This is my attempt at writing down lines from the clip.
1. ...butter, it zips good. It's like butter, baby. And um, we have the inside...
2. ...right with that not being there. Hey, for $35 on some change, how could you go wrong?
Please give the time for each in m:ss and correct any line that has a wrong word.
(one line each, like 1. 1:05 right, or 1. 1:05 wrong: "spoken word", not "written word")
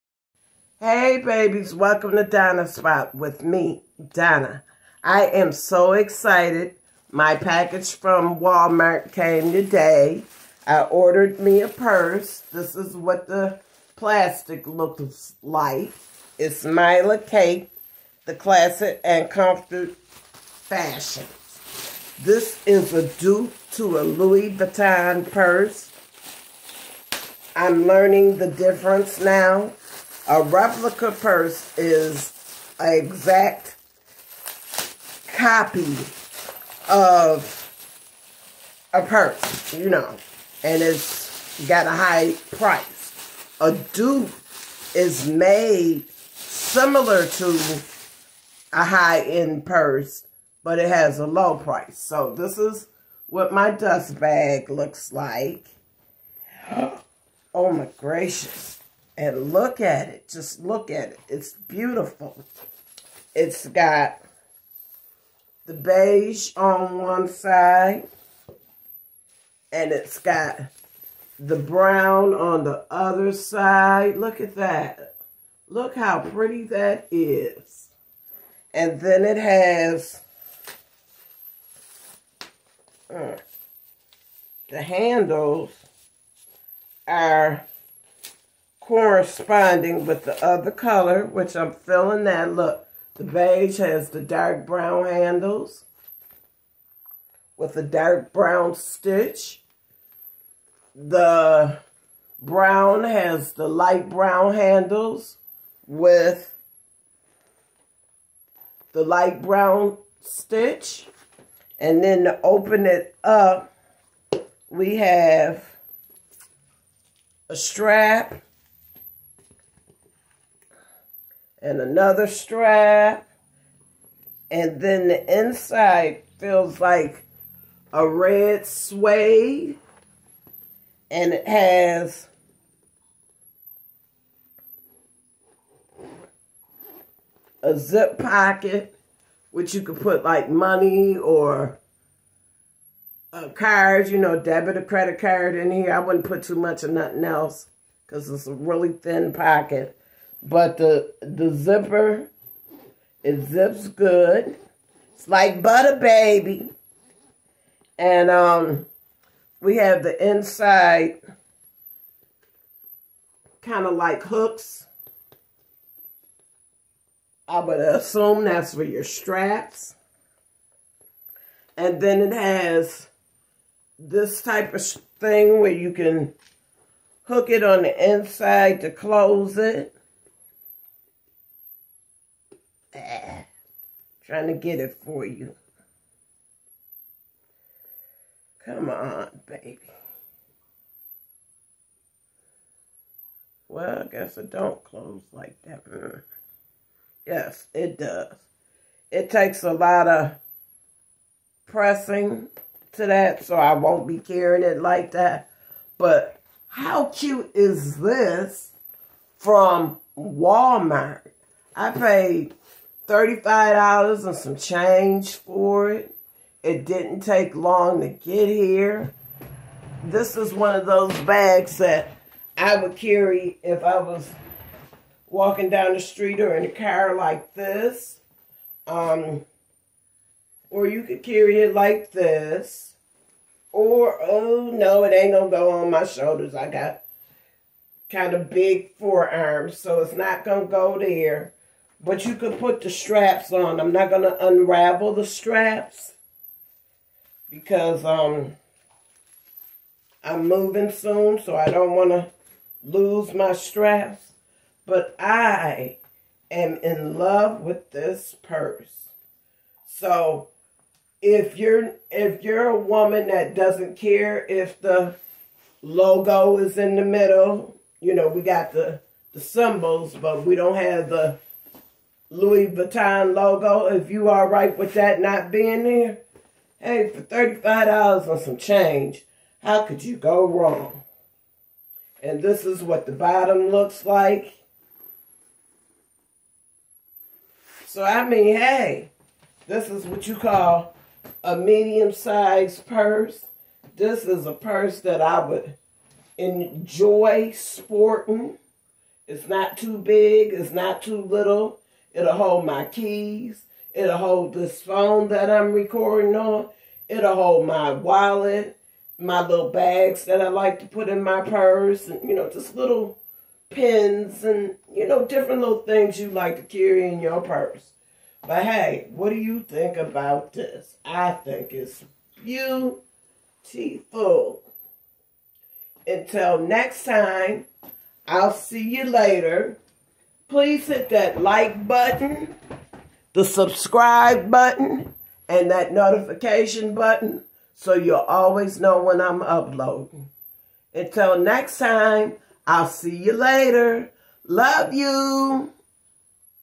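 1. 2:31 wrong: "zipper", not "butter"
2. 4:34 right.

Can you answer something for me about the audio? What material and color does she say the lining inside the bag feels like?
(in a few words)
Red suede.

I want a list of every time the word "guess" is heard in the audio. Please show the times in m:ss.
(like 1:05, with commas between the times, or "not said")
3:14.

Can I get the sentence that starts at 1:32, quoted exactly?
Look, the beige has the dark brown handles with a dark brown stitch.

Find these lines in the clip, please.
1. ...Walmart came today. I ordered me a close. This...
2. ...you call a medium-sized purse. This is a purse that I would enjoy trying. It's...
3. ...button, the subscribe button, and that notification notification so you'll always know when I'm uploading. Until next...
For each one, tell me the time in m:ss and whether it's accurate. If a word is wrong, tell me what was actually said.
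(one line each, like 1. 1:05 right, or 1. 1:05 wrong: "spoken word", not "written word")
1. 0:08 wrong: "purse", not "close"
2. 4:50 wrong: "sporting", not "trying"
3. 5:31 wrong: "button", not "notification".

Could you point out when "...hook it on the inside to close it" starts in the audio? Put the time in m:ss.
2:57.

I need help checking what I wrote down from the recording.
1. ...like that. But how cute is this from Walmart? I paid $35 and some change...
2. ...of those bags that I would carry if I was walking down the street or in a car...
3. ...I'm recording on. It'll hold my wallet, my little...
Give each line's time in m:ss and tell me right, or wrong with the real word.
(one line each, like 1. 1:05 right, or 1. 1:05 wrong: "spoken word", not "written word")
1. 3:24 right
2. 3:40 right
3. 5:05 right.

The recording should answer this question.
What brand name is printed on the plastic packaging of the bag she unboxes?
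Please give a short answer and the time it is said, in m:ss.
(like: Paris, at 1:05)
Mila Kate, at 0:16.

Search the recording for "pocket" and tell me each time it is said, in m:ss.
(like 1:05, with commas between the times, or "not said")
2:18, 2:29.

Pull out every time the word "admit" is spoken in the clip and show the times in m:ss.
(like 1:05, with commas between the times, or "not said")
not said.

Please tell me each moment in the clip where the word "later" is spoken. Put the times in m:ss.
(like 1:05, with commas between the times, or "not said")
5:29, 5:43.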